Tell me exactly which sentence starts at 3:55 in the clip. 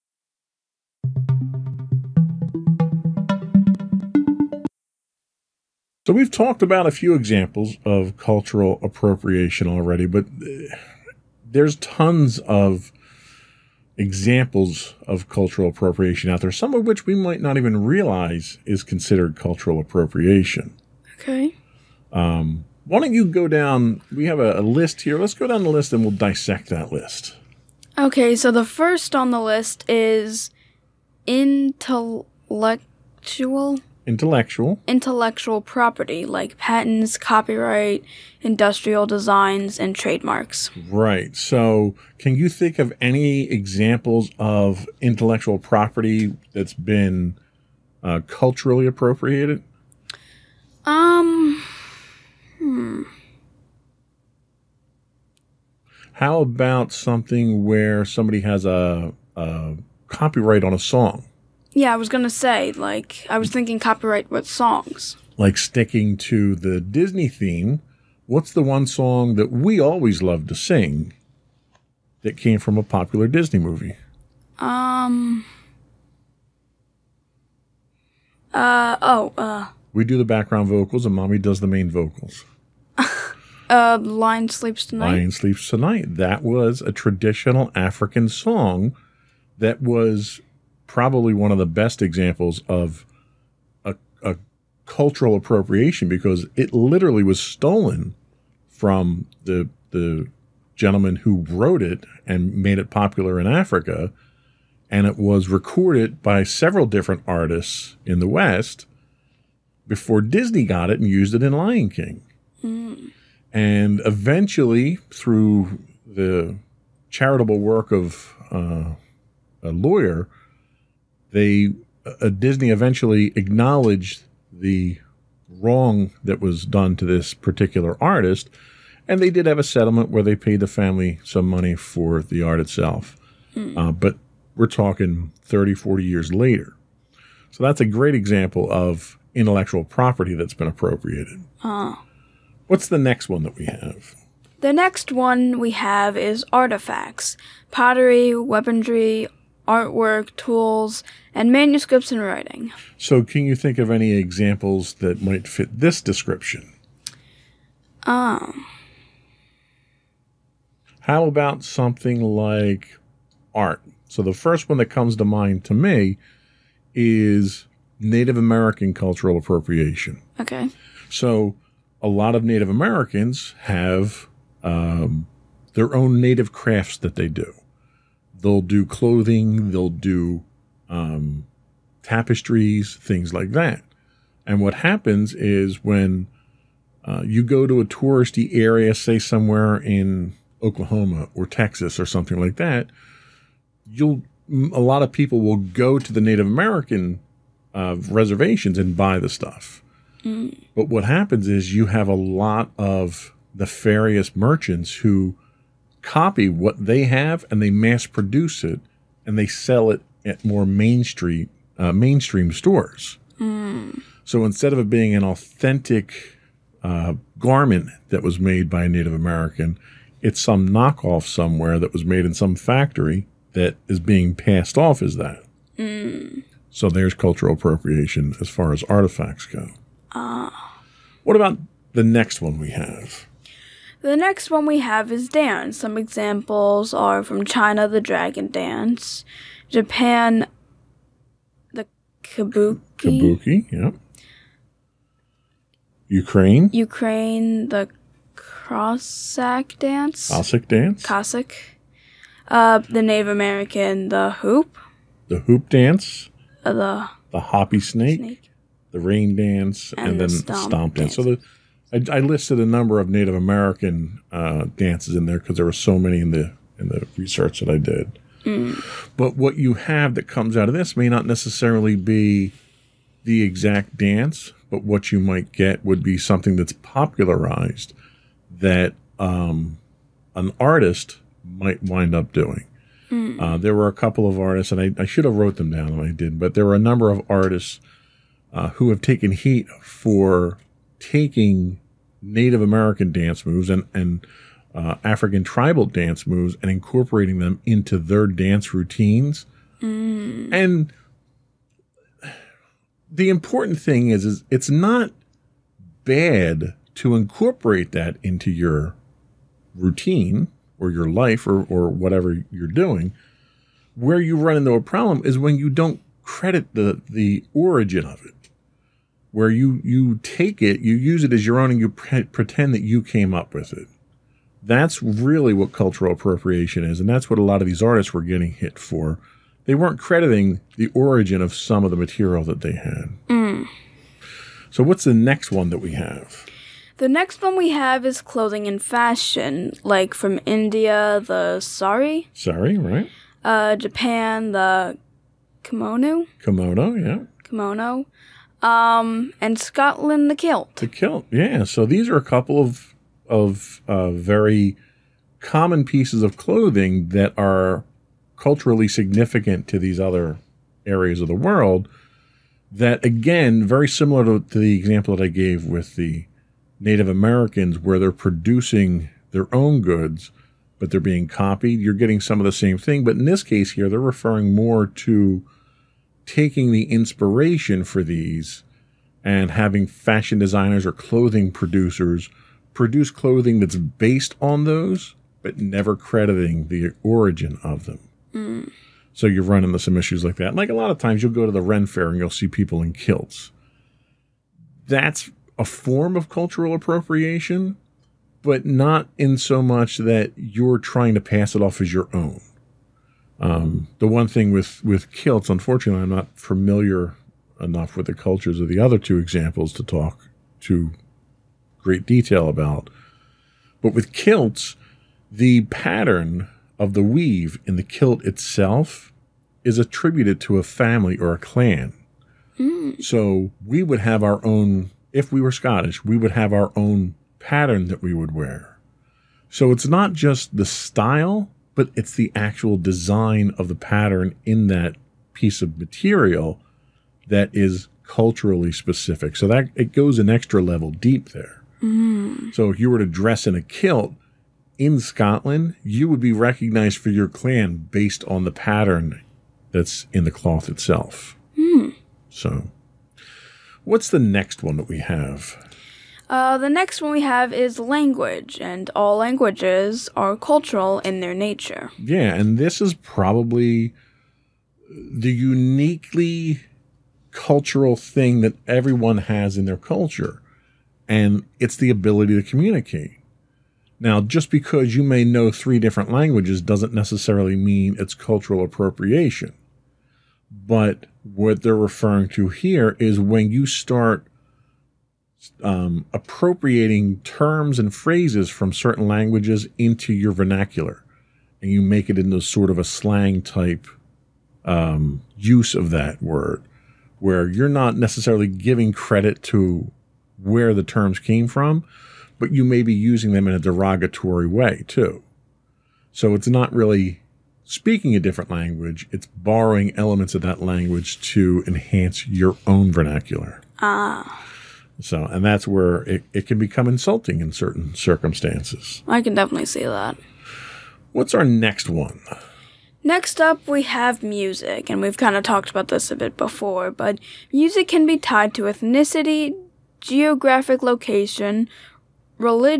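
Some examples are from China, the dragon dance, Japan, the kabuki.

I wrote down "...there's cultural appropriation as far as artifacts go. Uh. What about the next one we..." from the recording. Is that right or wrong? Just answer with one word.
right.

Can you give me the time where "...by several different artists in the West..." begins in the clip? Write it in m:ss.
1:46.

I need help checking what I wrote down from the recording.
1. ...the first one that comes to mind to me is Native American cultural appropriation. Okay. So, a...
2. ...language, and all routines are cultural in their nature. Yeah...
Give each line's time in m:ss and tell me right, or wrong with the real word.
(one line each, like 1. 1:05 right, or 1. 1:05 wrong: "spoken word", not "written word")
1. 2:44 right
2. 7:37 wrong: "languages", not "routines".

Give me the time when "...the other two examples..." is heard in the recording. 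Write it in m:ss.
6:48.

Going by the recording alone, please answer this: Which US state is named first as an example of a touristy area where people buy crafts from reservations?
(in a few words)
Oklahoma.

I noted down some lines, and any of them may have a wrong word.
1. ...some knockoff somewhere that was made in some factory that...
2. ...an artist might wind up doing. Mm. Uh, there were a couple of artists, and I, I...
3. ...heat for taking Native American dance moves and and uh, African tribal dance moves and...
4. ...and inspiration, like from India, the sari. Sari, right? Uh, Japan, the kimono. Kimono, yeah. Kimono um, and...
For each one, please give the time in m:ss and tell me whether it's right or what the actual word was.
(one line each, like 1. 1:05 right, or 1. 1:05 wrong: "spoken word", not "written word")
1. 3:40 right
2. 4:40 right
3. 4:49 right
4. 5:38 wrong: "fashion", not "inspiration".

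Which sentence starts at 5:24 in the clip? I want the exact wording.
That's really what cultural appropriation is, and that's what a lot of these artists were getting hit for.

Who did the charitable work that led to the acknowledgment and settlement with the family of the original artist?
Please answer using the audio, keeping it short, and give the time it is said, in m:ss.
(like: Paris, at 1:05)
A lawyer, at 1:59.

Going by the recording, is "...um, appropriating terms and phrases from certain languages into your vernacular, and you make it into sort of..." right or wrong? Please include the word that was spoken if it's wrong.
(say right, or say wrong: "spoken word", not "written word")
right.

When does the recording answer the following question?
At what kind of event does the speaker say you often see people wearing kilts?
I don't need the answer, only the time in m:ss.
6:31.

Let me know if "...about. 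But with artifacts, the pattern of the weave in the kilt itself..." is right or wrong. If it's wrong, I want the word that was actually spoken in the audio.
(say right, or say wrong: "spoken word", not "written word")
wrong: "kilts", not "artifacts".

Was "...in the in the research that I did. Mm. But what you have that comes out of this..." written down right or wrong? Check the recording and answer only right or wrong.
right.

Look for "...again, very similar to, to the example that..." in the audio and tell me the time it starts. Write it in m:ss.
6:03.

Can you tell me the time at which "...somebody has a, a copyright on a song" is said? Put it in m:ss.
0:58.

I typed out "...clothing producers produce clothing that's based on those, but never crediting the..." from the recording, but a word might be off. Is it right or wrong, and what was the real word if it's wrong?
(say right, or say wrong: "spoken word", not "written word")
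right.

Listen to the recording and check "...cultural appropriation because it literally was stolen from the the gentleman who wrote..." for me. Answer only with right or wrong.
right.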